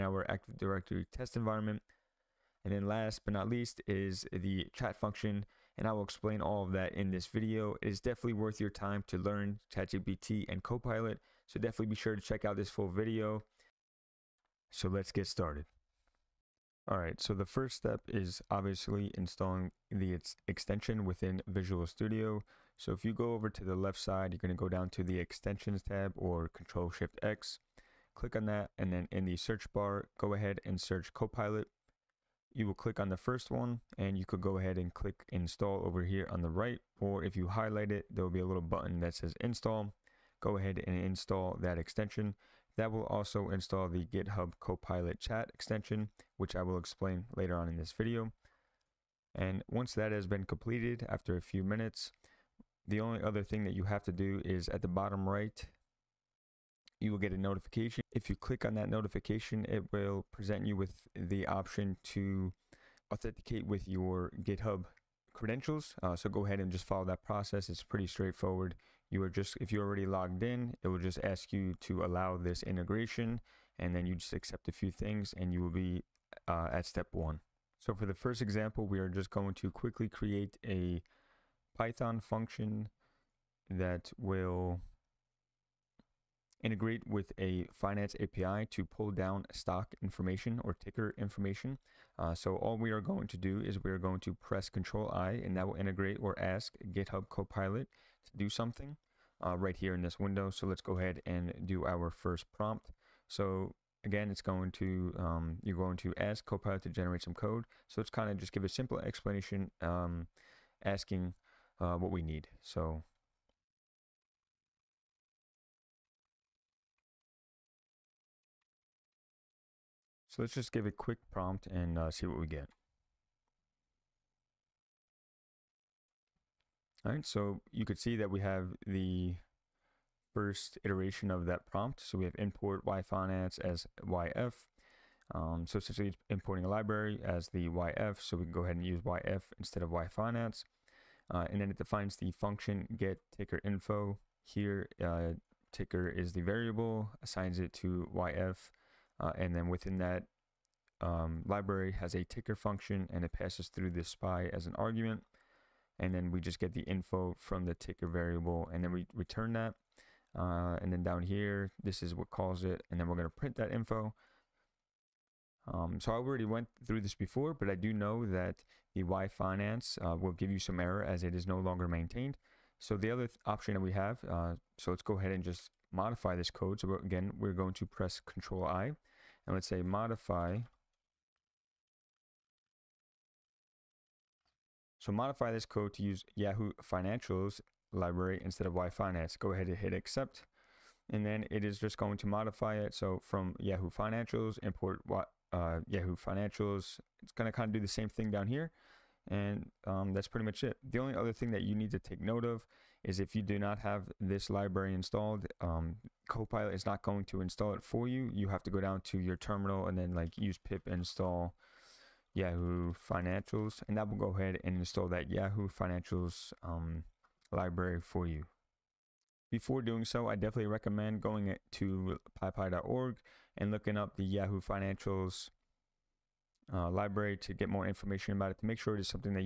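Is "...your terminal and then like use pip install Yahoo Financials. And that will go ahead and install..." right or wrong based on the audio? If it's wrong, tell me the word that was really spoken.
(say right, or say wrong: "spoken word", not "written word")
right.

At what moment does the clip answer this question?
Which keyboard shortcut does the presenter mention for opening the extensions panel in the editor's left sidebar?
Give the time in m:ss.
0:26.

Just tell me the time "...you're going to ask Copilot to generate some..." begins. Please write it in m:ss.
1:45.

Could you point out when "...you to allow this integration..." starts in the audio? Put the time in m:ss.
1:11.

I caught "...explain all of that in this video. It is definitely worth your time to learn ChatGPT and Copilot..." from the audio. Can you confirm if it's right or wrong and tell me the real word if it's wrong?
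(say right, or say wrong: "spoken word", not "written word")
right.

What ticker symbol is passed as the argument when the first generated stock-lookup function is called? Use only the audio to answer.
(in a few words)
SPY.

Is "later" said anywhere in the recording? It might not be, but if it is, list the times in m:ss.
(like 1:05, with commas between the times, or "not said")
0:47.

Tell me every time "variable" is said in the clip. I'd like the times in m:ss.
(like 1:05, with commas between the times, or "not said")
2:26, 2:38.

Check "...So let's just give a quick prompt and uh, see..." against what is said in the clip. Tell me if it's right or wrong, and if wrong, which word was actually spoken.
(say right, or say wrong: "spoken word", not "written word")
right.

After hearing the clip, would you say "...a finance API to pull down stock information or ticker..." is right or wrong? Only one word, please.
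right.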